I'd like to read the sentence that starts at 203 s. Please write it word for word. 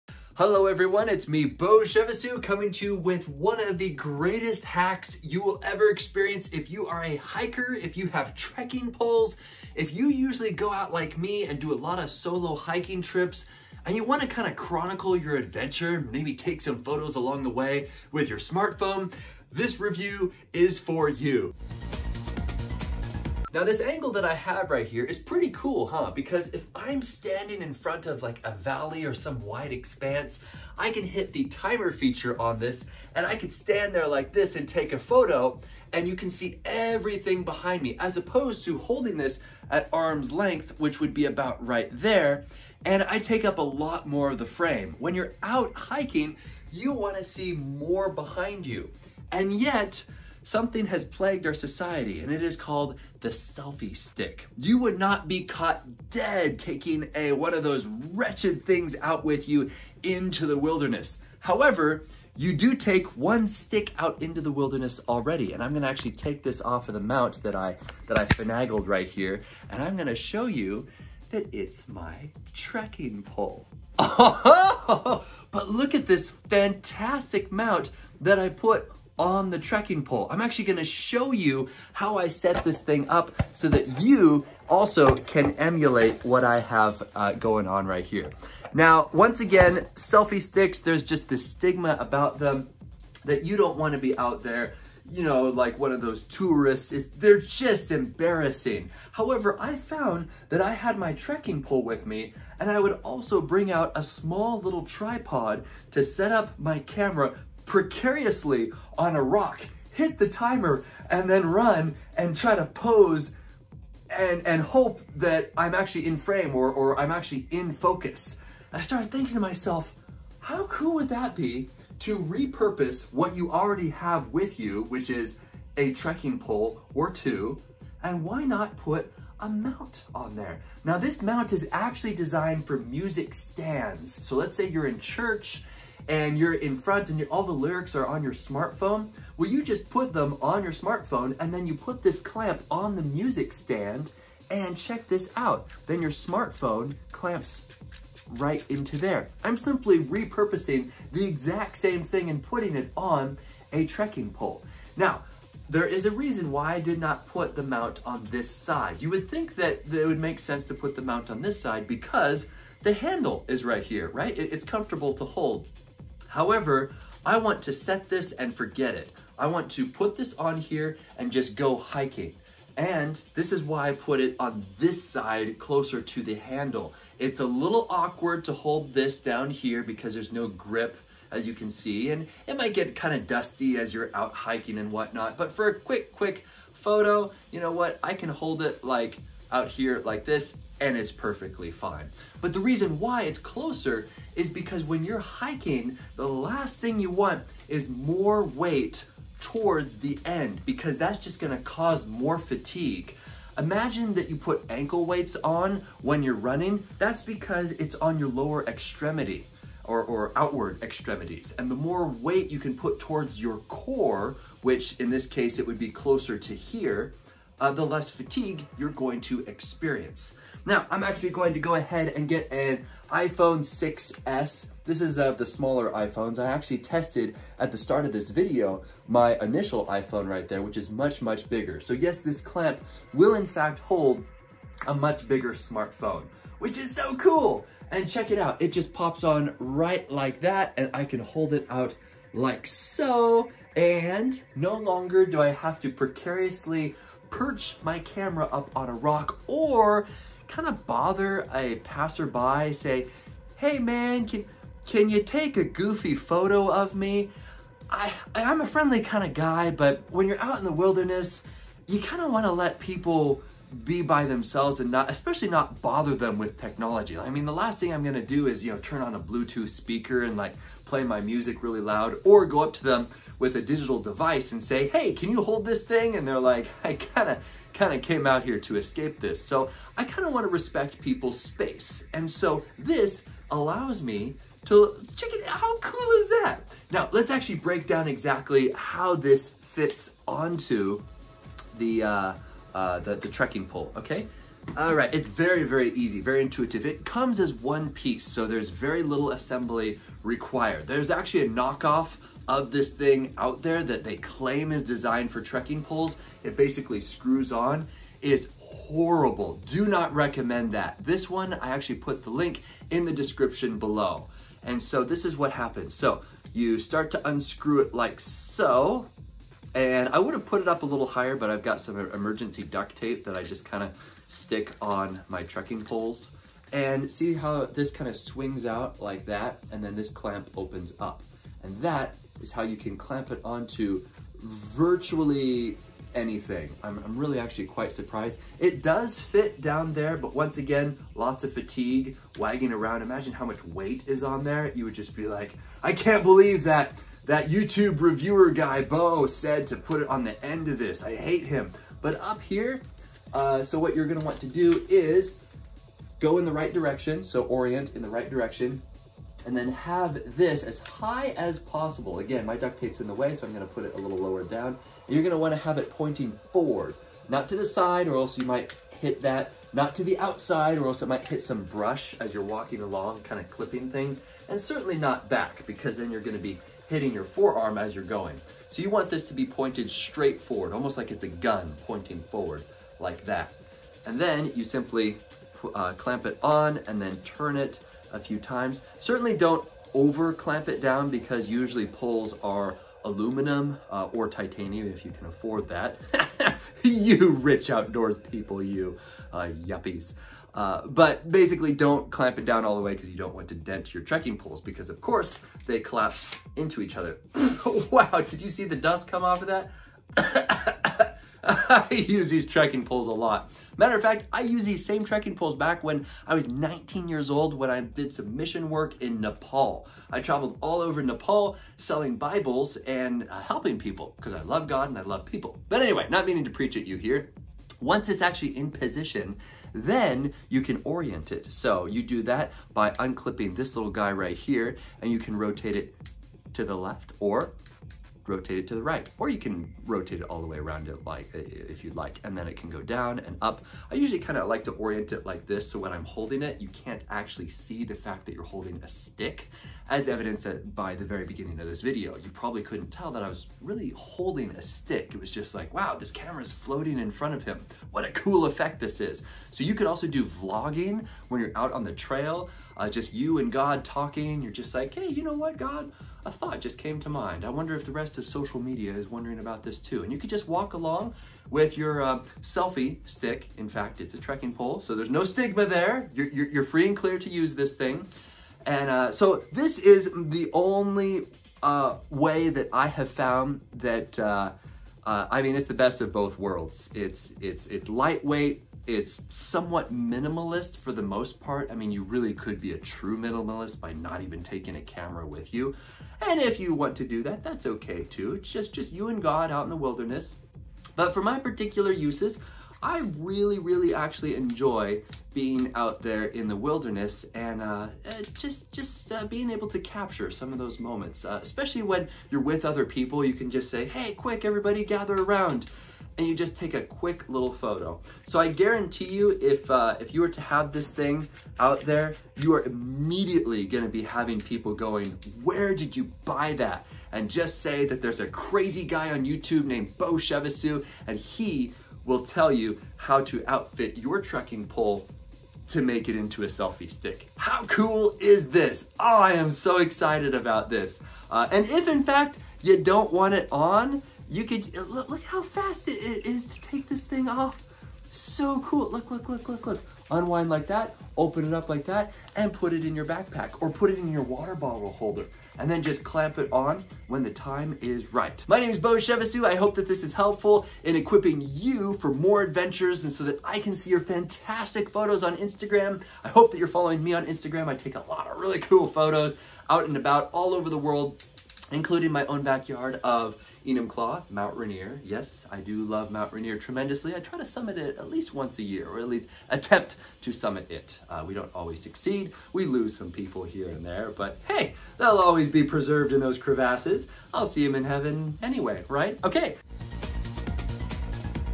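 Imagine that you put ankle weights on when you're running.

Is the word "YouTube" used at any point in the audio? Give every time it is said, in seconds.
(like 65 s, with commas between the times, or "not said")
347 s, 529 s.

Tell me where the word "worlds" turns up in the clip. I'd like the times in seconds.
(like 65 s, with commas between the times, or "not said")
486 s, 570 s.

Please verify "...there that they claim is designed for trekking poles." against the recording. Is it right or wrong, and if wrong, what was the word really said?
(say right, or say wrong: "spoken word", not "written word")
right.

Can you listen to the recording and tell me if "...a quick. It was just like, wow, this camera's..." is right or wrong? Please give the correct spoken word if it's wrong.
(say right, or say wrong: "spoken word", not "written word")
wrong: "stick", not "quick".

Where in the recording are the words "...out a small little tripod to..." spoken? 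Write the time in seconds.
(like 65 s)
103 s.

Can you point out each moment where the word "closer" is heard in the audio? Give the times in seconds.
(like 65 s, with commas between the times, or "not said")
175 s, 193 s, 215 s.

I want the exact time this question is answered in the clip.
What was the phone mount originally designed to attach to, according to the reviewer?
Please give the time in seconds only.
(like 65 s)
132 s.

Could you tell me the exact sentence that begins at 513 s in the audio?
You can just say, "Hey, quick, everybody, gather around!" and you just take a quick little photo.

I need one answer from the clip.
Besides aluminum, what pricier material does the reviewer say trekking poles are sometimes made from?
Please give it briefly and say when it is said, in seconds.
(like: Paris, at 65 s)
Titanium, at 394 s.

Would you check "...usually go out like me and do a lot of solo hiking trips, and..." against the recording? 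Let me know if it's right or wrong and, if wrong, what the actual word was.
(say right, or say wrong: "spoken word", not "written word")
right.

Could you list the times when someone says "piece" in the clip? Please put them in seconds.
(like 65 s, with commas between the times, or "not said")
297 s.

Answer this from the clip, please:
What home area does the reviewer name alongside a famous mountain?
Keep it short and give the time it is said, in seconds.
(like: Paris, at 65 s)
Enumclaw, at 573 s.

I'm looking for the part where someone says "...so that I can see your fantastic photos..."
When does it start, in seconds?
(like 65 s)
563 s.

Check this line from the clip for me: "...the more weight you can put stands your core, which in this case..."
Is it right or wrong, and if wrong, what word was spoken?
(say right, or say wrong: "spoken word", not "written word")
wrong: "towards", not "stands".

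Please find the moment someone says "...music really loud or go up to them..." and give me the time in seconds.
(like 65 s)
271 s.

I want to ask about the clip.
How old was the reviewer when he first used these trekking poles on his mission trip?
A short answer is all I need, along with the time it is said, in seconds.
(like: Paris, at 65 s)
19, at 416 s.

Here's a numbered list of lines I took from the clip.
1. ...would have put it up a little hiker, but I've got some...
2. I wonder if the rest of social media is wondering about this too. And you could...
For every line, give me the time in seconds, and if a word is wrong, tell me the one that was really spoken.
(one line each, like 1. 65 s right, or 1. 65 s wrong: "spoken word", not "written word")
1. 320 s wrong: "higher", not "hiker"
2. 467 s right.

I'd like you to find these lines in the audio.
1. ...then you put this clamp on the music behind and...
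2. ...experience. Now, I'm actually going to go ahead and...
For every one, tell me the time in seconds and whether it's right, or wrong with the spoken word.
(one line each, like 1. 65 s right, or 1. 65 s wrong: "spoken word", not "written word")
1. 141 s wrong: "stand", not "behind"
2. 219 s right.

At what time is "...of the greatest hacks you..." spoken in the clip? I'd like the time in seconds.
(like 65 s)
3 s.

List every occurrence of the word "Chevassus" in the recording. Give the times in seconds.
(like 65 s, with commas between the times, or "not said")
1 s, 530 s, 558 s.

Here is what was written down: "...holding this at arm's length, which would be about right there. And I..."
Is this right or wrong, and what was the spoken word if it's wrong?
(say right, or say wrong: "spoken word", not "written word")
right.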